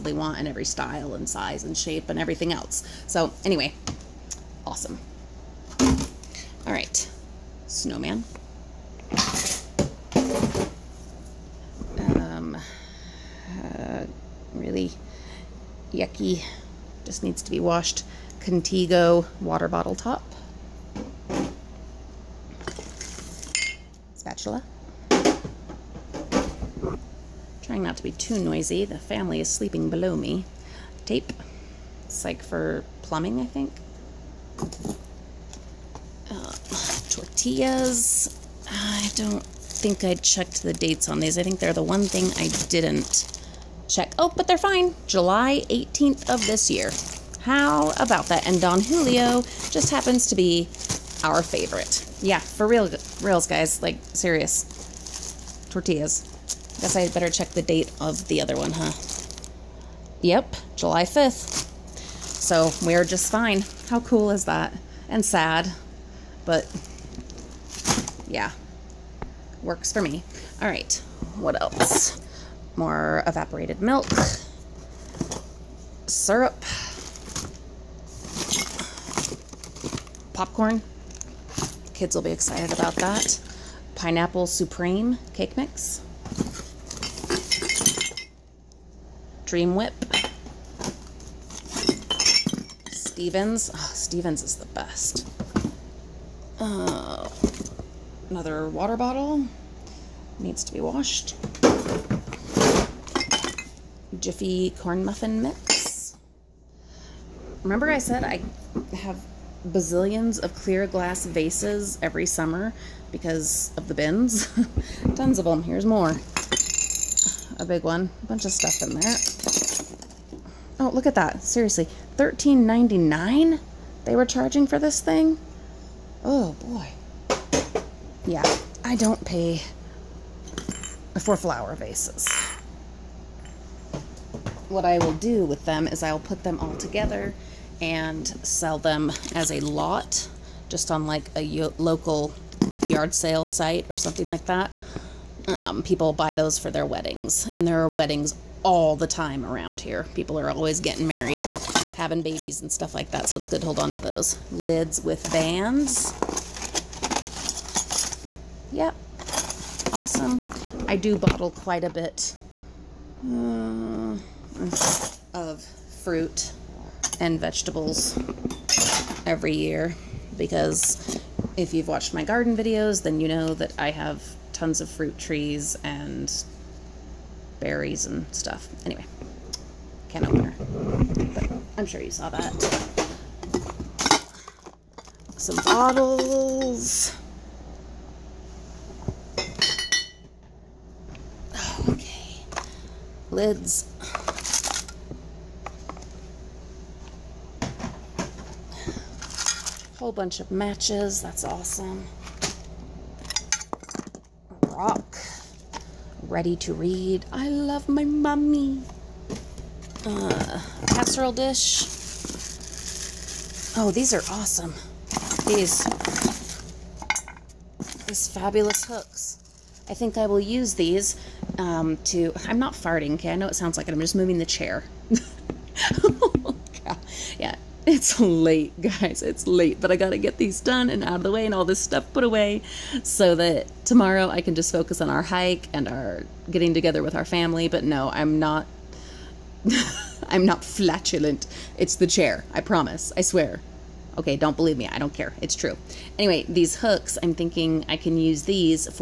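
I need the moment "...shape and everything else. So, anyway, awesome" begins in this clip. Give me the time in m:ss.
0:01.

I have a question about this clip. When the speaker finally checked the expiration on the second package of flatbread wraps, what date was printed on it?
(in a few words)
July 5th.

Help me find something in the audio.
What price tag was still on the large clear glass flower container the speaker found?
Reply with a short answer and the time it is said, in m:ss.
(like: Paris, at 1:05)
$13.99, at 2:02.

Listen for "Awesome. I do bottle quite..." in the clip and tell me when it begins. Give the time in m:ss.
2:39.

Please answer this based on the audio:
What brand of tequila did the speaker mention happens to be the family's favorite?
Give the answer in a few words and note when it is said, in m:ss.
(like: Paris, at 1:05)
Don Julio, at 0:48.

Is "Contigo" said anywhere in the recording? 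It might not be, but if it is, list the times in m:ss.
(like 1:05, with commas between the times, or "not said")
0:18.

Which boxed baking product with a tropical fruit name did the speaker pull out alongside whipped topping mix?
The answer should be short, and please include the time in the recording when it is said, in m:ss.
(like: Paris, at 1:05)
Pineapple Supreme cake mix, at 1:23.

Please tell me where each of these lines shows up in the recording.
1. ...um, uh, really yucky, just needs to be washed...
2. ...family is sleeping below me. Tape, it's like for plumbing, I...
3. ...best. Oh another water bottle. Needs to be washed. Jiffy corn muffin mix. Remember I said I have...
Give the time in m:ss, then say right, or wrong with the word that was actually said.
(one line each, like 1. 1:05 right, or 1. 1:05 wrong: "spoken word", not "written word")
1. 0:11 right
2. 0:28 right
3. 1:34 right.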